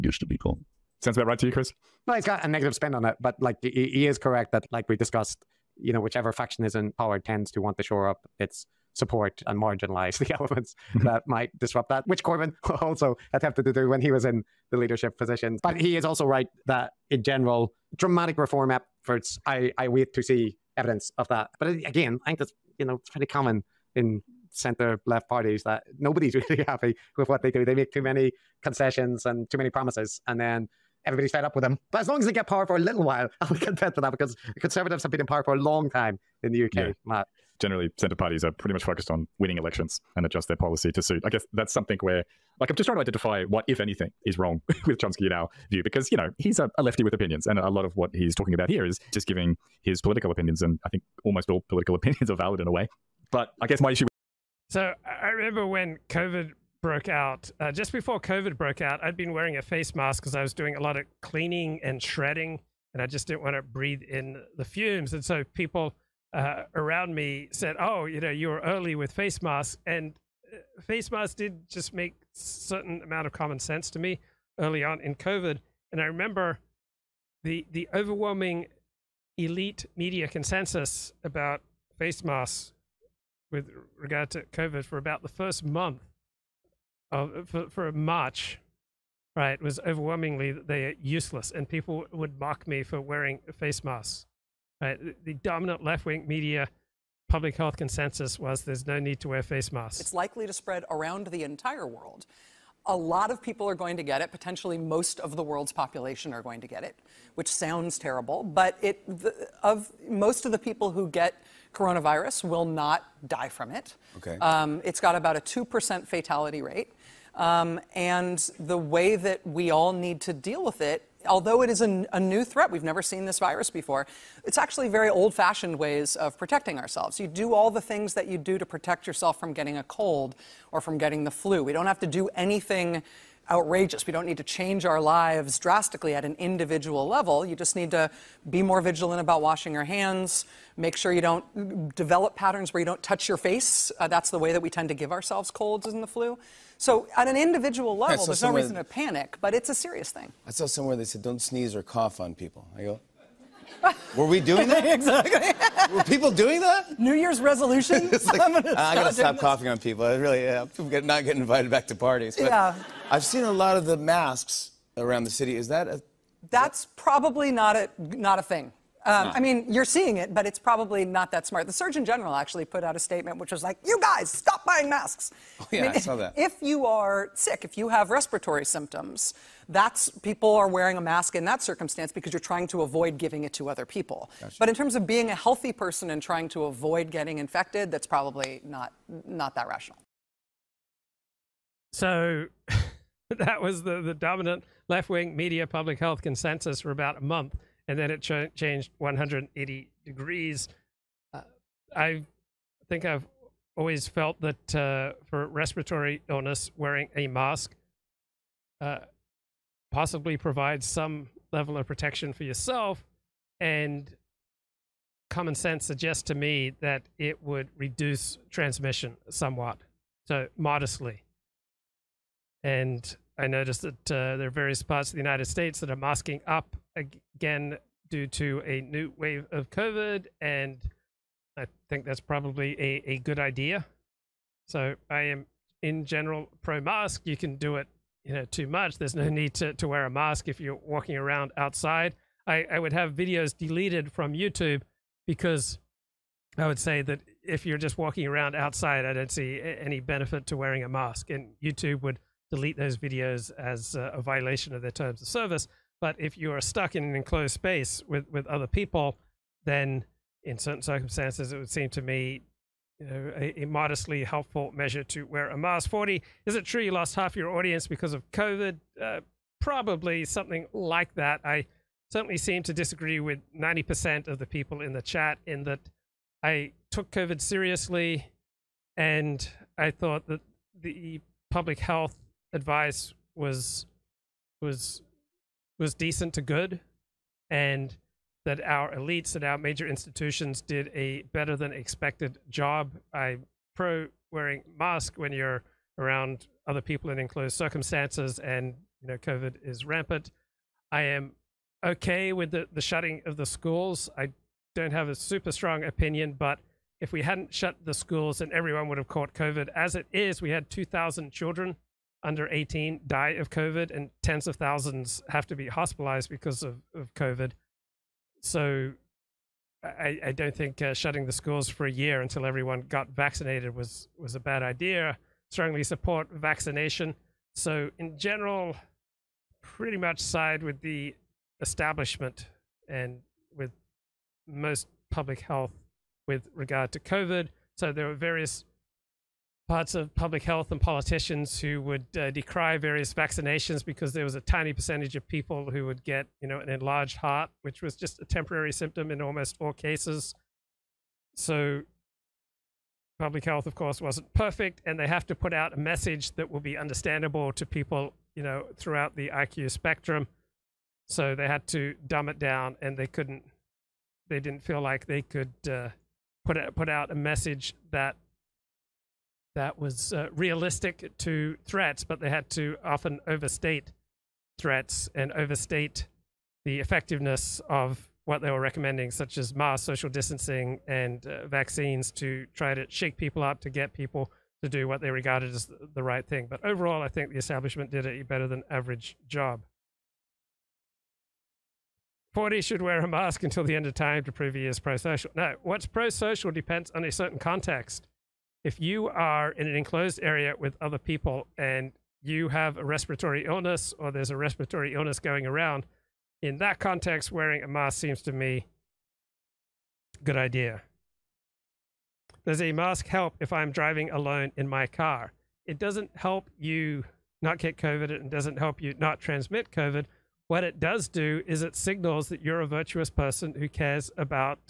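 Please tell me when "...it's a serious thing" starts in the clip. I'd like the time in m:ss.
2:29.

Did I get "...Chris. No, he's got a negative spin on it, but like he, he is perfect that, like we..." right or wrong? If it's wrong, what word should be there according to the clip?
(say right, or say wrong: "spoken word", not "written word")
wrong: "correct", not "perfect".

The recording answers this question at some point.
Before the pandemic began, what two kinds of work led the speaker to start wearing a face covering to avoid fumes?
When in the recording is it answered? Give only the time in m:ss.
1:01.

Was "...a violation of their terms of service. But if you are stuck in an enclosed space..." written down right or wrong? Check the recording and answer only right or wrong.
right.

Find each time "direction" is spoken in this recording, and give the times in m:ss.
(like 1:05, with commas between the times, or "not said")
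not said.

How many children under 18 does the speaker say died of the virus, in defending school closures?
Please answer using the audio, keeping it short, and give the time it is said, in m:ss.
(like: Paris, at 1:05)
2,000, at 5:10.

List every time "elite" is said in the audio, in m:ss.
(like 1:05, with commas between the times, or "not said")
1:19, 4:48.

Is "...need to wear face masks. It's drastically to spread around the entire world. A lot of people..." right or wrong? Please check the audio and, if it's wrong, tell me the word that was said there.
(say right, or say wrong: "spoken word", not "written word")
wrong: "likely", not "drastically".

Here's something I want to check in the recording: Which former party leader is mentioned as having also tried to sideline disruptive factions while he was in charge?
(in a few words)
Corbyn.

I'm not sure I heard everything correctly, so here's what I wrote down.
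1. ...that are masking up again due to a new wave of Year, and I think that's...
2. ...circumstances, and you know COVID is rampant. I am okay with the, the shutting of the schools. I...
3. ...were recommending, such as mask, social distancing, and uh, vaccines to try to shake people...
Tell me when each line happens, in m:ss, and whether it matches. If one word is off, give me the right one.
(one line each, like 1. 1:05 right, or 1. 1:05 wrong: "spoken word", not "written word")
1. 3:45 wrong: "COVID", not "Year"
2. 4:57 right
3. 6:18 right.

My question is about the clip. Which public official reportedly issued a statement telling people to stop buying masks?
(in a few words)
The Surgeon General.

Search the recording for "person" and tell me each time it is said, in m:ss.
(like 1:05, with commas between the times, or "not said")
3:05, 7:03.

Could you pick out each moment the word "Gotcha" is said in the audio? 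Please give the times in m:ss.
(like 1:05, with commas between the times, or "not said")
3:04.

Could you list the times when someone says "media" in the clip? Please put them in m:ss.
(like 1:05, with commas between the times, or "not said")
1:19, 1:36, 3:15.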